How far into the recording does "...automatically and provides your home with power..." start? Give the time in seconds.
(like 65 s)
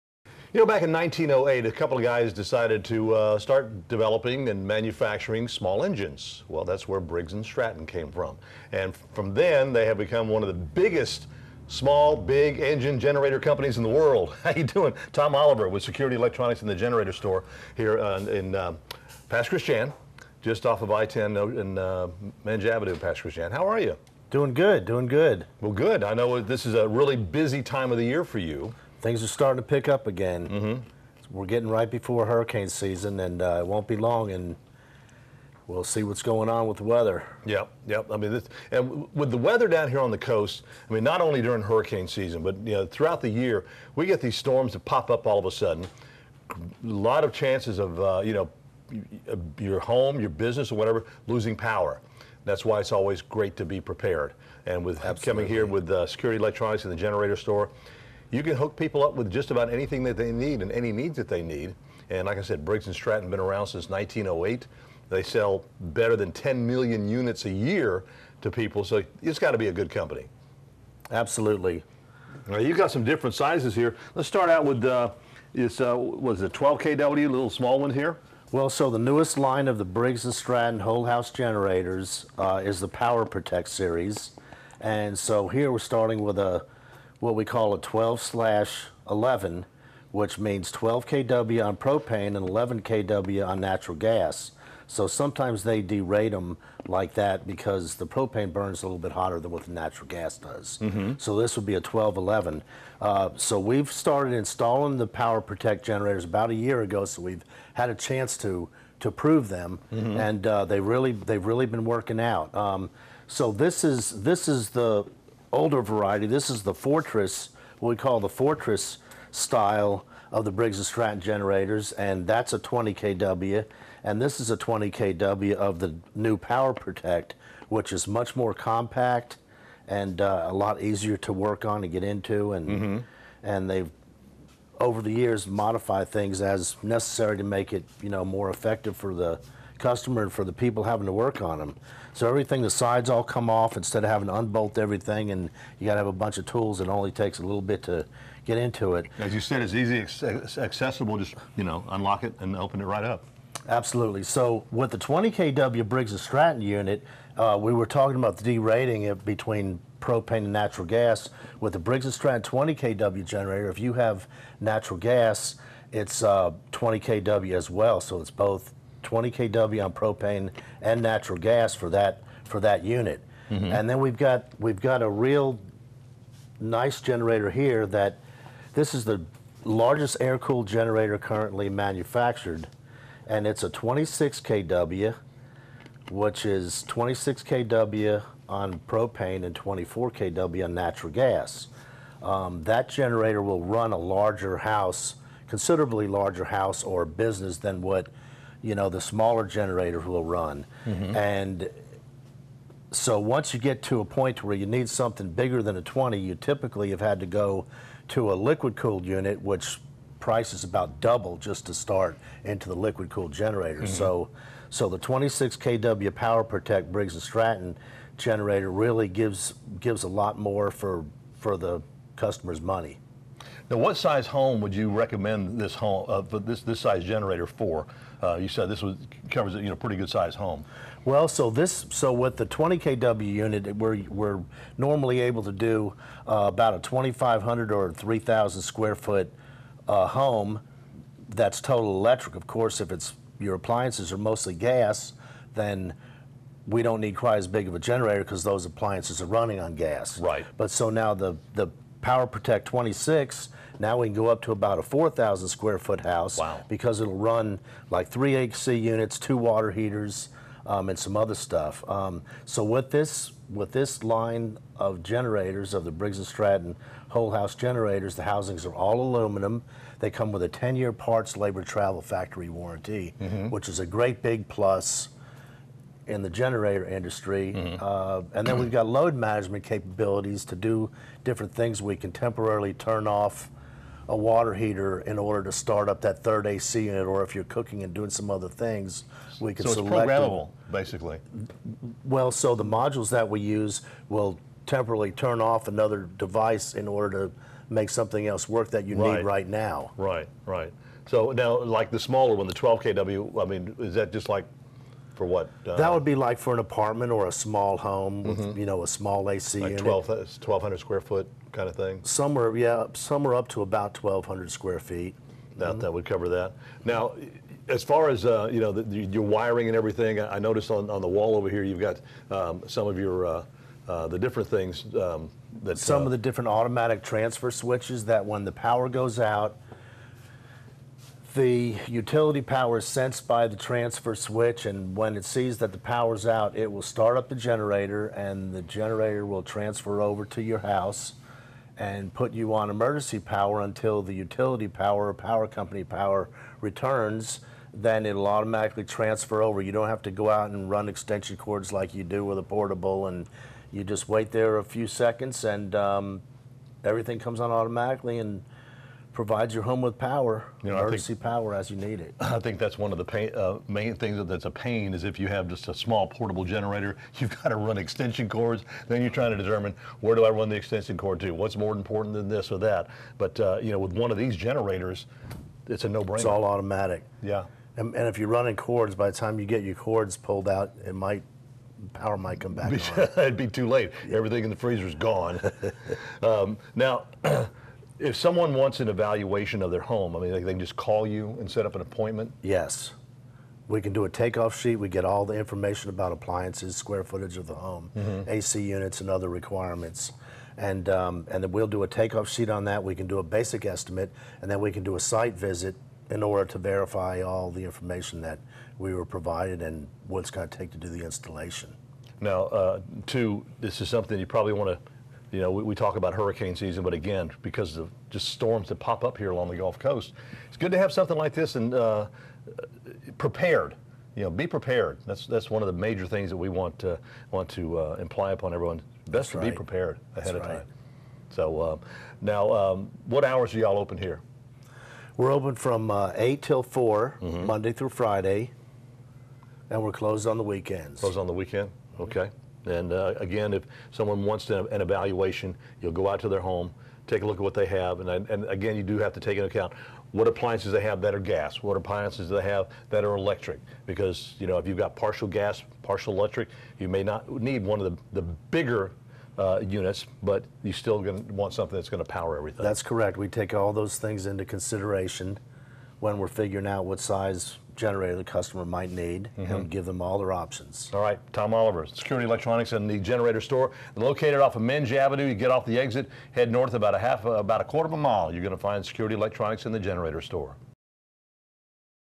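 357 s.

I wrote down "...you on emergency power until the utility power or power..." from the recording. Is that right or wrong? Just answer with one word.
right.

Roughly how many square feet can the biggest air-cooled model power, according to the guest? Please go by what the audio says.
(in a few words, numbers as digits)
4,000.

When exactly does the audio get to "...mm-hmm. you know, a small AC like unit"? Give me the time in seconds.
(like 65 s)
308 s.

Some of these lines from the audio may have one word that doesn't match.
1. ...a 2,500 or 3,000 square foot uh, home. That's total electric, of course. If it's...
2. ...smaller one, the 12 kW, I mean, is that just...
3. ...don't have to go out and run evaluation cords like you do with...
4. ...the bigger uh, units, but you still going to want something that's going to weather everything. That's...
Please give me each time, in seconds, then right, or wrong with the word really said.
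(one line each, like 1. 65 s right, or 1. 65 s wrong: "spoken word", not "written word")
1. 236 s right
2. 301 s right
3. 349 s wrong: "extension", not "evaluation"
4. 458 s wrong: "power", not "weather".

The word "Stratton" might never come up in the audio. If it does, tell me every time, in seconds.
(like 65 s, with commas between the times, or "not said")
7 s, 62 s, 80 s, 120 s, 156 s, 162 s, 217 s, 266 s.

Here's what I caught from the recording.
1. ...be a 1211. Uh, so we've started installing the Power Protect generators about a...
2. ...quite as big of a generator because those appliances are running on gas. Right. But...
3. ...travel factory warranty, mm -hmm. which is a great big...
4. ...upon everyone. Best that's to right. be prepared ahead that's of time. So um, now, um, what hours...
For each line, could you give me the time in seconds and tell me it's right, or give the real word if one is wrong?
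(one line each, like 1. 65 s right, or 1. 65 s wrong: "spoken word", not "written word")
1. 101 s right
2. 247 s right
3. 271 s right
4. 428 s right.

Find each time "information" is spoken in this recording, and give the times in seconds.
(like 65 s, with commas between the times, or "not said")
395 s, 407 s.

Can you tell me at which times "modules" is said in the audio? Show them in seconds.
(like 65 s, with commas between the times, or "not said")
292 s.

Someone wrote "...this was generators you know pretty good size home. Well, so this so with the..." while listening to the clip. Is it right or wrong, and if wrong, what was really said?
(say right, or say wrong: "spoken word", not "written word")
wrong: "covers", not "generators".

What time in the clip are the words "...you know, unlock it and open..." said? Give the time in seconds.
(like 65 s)
151 s.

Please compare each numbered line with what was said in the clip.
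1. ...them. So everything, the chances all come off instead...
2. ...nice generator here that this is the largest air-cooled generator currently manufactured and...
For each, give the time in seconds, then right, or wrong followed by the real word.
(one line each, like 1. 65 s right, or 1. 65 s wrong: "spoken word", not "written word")
1. 141 s wrong: "sides", not "chances"
2. 176 s right.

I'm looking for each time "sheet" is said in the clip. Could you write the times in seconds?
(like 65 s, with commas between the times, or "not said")
394 s, 402 s.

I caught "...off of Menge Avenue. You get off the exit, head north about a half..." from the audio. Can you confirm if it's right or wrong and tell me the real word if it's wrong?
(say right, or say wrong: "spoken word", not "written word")
right.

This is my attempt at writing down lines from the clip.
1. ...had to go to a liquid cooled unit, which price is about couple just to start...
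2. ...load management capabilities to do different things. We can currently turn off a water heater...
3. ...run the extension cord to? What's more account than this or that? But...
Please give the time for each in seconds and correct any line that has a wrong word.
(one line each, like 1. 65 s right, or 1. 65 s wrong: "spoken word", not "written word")
1. 206 s wrong: "double", not "couple"
2. 278 s wrong: "temporarily", not "currently"
3. 370 s wrong: "important", not "account".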